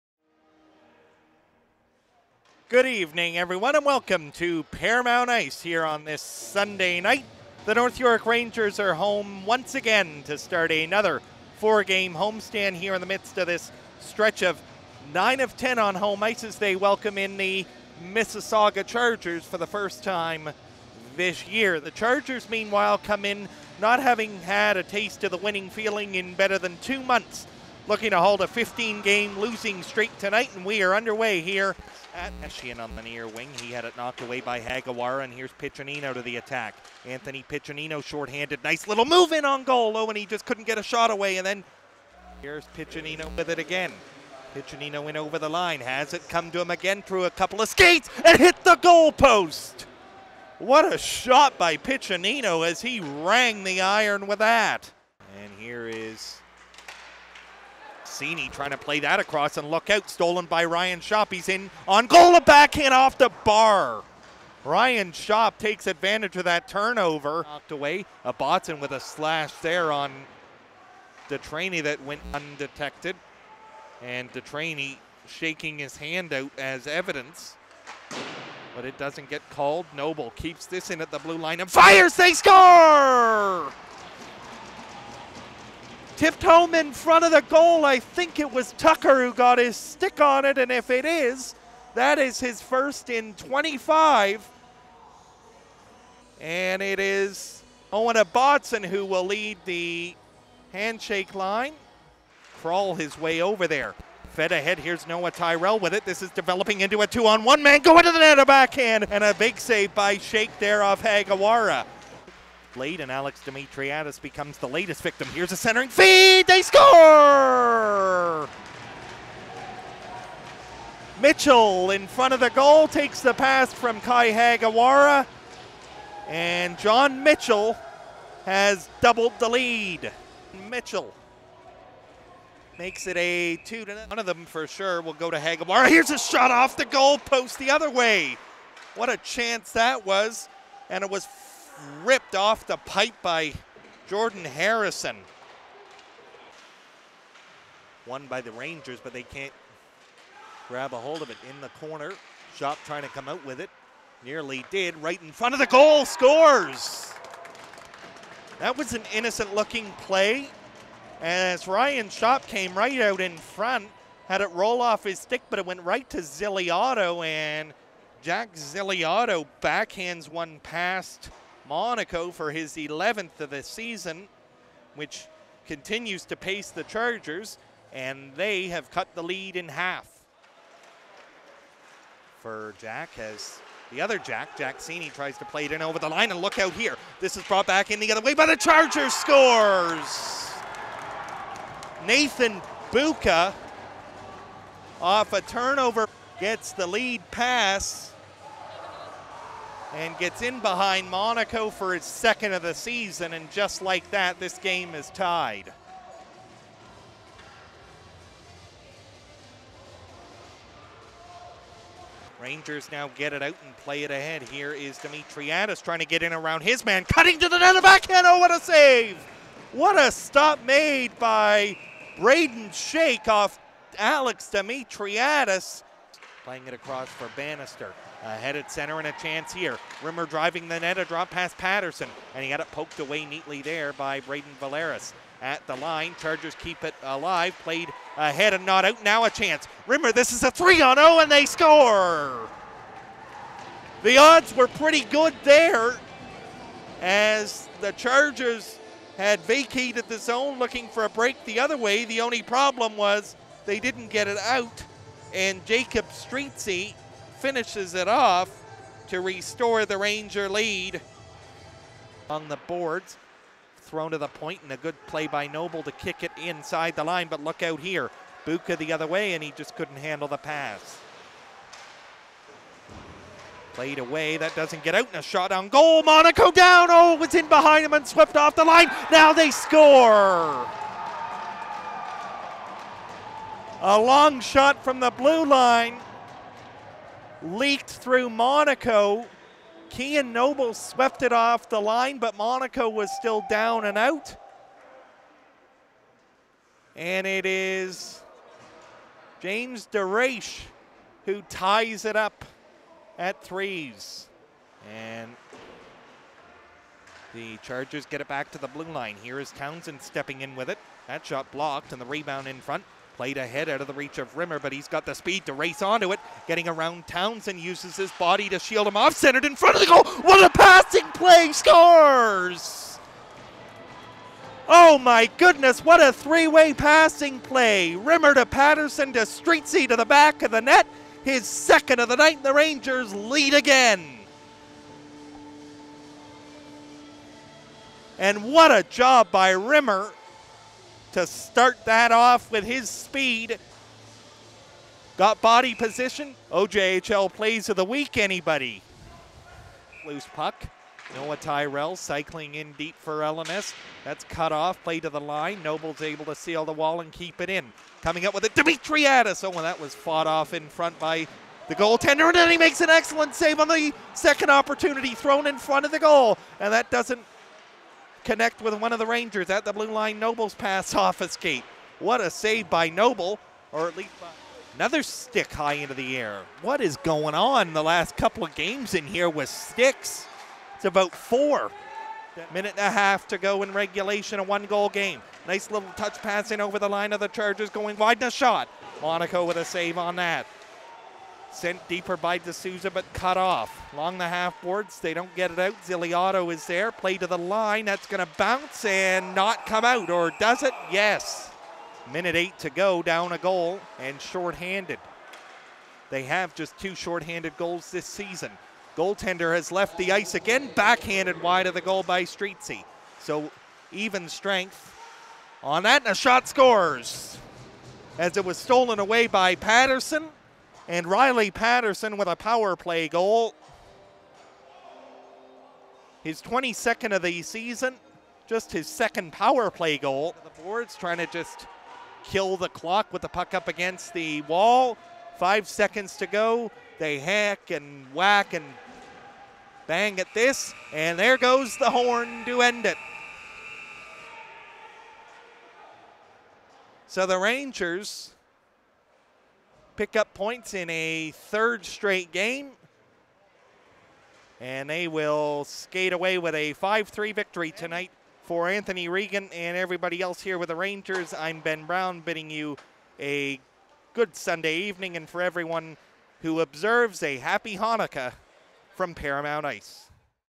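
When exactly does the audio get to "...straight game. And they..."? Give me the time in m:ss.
7:31.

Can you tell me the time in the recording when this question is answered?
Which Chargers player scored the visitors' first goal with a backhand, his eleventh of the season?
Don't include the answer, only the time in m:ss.
2:48.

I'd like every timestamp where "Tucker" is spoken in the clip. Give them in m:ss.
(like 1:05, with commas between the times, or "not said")
1:28.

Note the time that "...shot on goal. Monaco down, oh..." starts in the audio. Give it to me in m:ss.
4:35.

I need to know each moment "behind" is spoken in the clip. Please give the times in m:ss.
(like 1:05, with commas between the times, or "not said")
3:20, 4:37.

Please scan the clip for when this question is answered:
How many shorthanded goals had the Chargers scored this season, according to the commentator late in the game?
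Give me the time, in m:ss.
6:46.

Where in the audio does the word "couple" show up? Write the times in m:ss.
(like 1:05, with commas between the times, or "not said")
0:47, 6:18.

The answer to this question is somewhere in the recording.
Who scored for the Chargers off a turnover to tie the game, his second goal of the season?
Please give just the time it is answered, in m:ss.
3:12.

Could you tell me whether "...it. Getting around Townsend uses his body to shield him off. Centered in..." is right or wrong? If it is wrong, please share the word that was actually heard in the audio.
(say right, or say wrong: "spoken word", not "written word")
right.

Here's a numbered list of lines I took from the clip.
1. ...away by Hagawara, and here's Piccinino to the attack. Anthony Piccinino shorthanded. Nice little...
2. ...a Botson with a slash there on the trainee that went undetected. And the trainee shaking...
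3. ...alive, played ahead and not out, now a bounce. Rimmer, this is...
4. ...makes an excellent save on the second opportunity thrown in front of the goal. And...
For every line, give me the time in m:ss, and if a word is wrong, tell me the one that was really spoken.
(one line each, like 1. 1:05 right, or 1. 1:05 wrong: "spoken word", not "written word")
1. 0:34 right
2. 1:08 right
3. 3:57 wrong: "chance", not "bounce"
4. 6:02 right.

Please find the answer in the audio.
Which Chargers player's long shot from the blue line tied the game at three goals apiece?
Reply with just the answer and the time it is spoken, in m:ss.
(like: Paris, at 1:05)
James DeRaish, at 4:59.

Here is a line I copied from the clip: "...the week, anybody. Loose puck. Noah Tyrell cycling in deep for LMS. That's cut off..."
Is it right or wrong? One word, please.
right.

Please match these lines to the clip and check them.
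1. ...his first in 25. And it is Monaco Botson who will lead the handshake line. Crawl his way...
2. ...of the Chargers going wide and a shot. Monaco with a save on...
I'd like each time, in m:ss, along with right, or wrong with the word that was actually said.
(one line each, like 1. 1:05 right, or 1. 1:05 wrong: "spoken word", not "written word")
1. 1:32 wrong: "Owen", not "Monaco"
2. 6:27 right.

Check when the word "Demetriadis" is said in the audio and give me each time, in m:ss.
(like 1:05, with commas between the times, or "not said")
3:34, 3:44.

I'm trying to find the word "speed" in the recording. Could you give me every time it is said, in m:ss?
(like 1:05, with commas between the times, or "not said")
5:15, 5:42.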